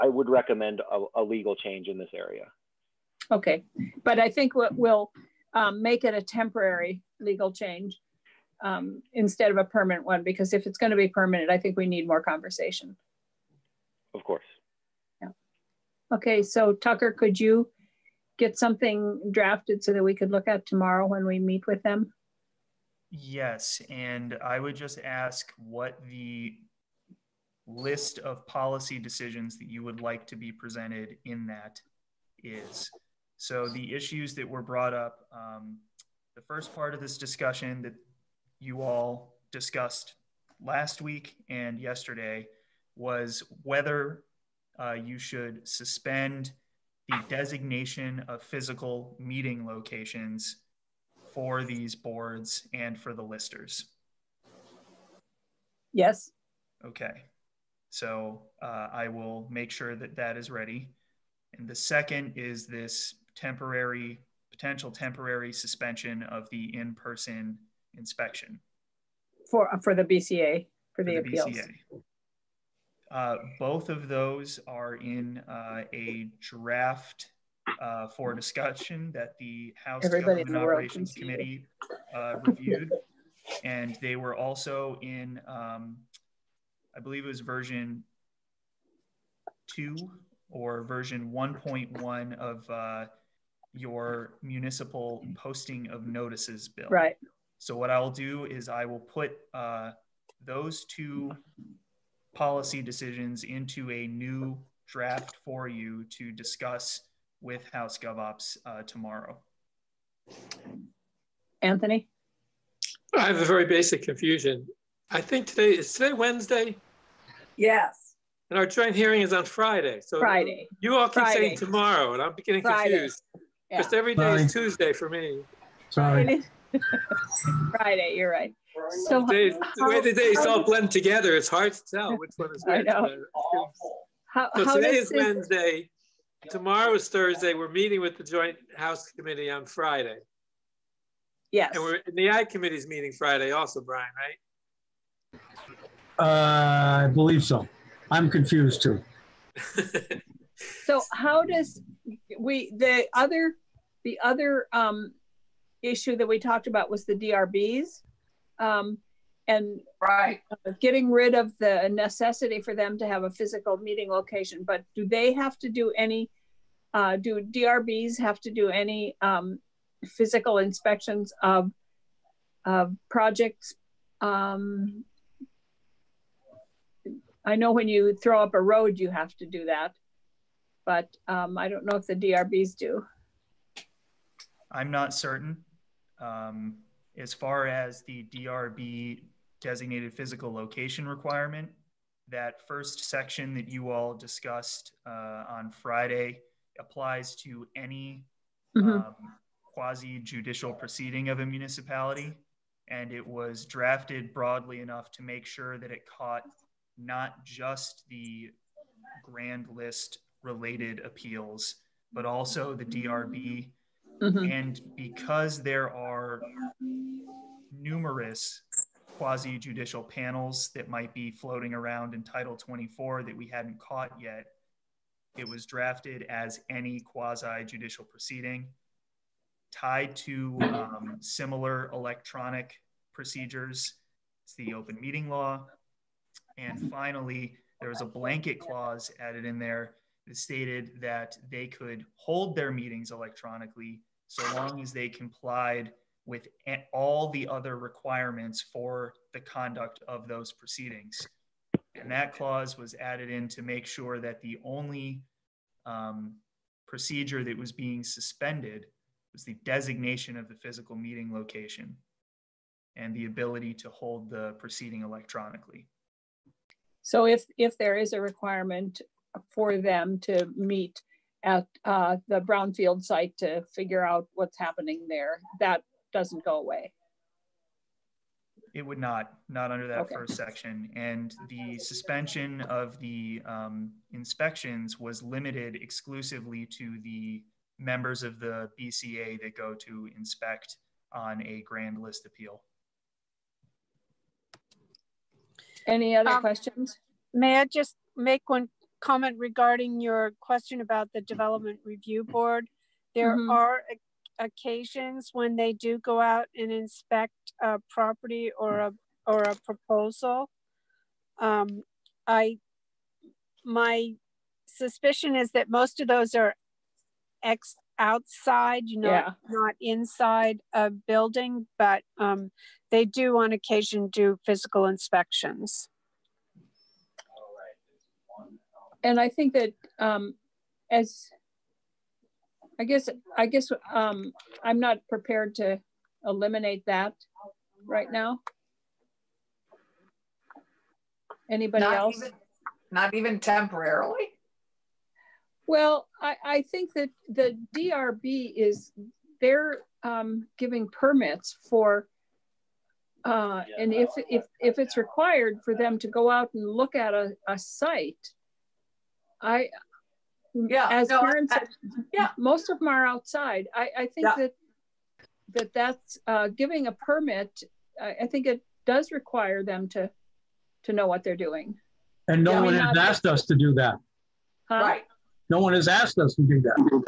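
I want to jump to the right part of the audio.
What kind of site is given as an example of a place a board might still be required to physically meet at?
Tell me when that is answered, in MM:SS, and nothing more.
04:32.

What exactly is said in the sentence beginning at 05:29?
and I think that um, as I guess I guess um, I'm not prepared to eliminate that right now.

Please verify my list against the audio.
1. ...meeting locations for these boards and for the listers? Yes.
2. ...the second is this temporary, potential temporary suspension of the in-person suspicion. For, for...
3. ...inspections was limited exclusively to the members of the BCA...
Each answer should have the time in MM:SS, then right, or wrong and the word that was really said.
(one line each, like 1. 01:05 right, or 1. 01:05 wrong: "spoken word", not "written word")
1. 00:49 right
2. 01:01 wrong: "inspection", not "suspicion"
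3. 04:44 right.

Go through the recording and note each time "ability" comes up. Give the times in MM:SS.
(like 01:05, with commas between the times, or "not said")
04:23.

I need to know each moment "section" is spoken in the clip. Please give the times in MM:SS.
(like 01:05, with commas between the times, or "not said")
03:13, 04:40.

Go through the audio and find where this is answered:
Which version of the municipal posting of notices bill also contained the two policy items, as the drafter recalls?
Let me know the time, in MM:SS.
01:30.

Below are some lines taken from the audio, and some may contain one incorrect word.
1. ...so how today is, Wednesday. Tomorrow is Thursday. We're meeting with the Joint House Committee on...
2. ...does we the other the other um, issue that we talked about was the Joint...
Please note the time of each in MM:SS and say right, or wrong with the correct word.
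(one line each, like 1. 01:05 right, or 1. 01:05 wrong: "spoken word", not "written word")
1. 02:14 right
2. 02:31 wrong: "DRBs", not "Joint".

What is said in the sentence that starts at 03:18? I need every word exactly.
um, quasi judicial proceeding of a municipality.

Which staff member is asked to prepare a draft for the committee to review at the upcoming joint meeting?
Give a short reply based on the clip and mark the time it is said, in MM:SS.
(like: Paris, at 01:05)
Tucker, at 00:16.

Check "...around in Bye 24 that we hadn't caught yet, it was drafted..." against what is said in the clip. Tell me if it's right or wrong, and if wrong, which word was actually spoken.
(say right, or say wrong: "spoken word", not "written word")
wrong: "Title", not "Bye".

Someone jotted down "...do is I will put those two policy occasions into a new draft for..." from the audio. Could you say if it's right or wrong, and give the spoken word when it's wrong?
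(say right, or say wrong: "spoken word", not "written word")
wrong: "decisions", not "occasions".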